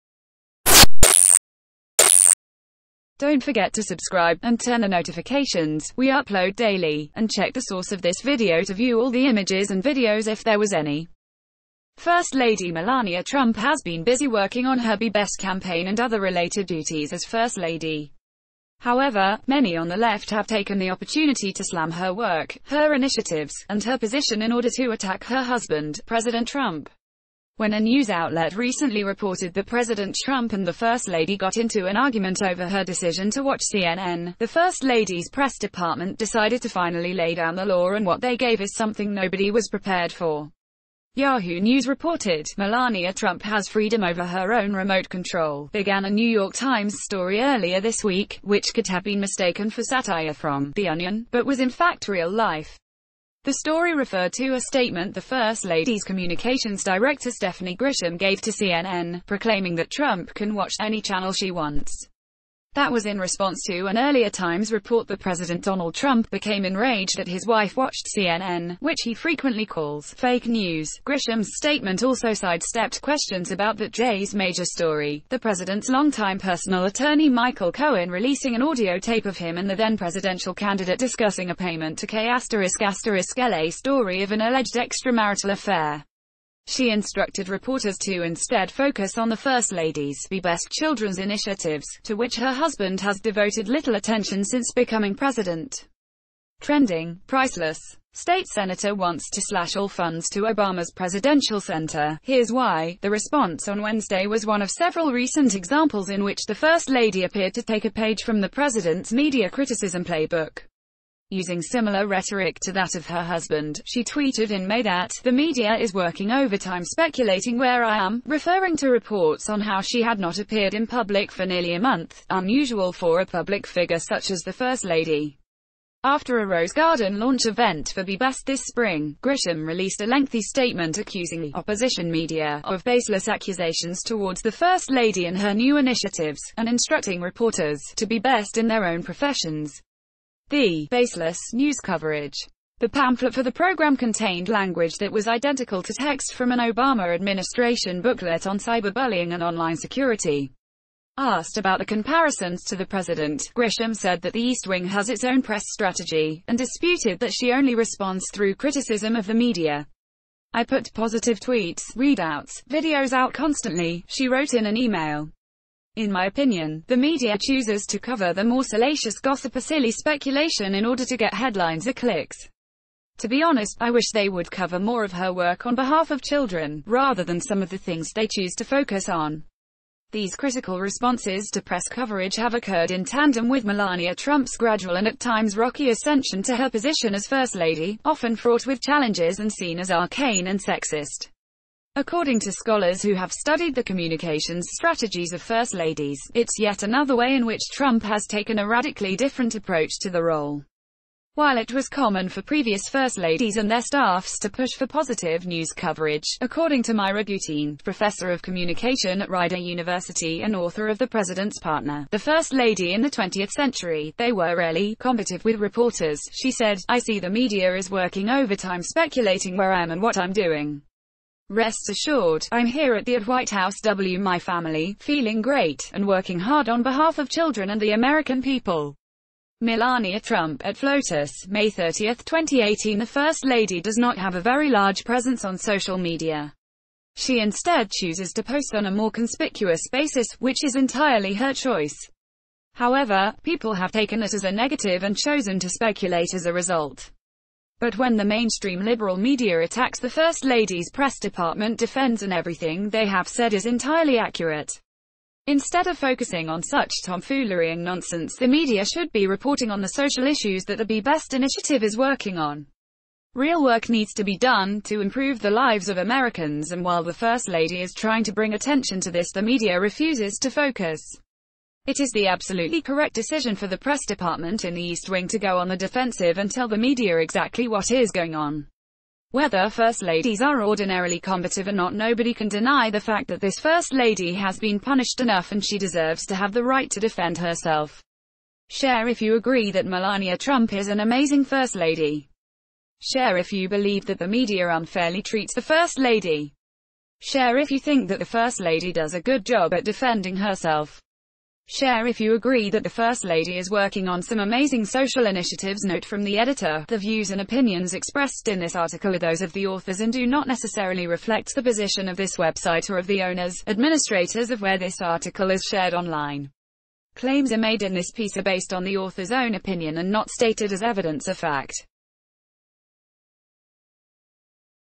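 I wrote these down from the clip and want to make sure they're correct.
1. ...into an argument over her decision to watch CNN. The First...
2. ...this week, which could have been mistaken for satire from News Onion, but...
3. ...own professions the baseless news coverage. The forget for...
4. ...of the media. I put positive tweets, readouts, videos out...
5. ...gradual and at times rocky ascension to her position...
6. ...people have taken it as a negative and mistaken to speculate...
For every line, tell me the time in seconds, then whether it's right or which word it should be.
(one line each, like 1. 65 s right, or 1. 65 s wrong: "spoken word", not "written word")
1. 31 s right
2. 47 s wrong: "The", not "News"
3. 138 s wrong: "pamphlet", not "forget"
4. 159 s right
5. 184 s right
6. 243 s wrong: "chosen", not "mistaken".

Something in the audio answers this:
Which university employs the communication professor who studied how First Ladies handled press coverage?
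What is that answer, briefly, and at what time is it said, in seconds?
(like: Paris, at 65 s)
Rider University, at 209 s.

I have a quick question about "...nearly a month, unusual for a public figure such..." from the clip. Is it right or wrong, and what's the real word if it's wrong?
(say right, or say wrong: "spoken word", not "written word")
right.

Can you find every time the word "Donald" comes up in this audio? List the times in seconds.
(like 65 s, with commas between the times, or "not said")
65 s.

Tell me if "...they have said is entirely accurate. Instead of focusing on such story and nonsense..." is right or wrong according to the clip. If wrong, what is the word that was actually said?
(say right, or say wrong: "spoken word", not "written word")
wrong: "tomfoolery", not "story".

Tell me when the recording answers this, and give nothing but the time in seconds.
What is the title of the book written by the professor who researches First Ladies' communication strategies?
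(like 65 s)
210 s.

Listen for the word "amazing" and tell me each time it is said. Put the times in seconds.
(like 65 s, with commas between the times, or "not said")
290 s, 304 s.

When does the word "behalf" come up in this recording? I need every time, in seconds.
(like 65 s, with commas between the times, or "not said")
175 s, 226 s.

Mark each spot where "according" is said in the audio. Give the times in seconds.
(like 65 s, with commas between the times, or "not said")
191 s, 206 s.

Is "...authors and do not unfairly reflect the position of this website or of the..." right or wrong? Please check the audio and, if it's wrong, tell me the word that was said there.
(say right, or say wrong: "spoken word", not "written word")
wrong: "necessarily", not "unfairly".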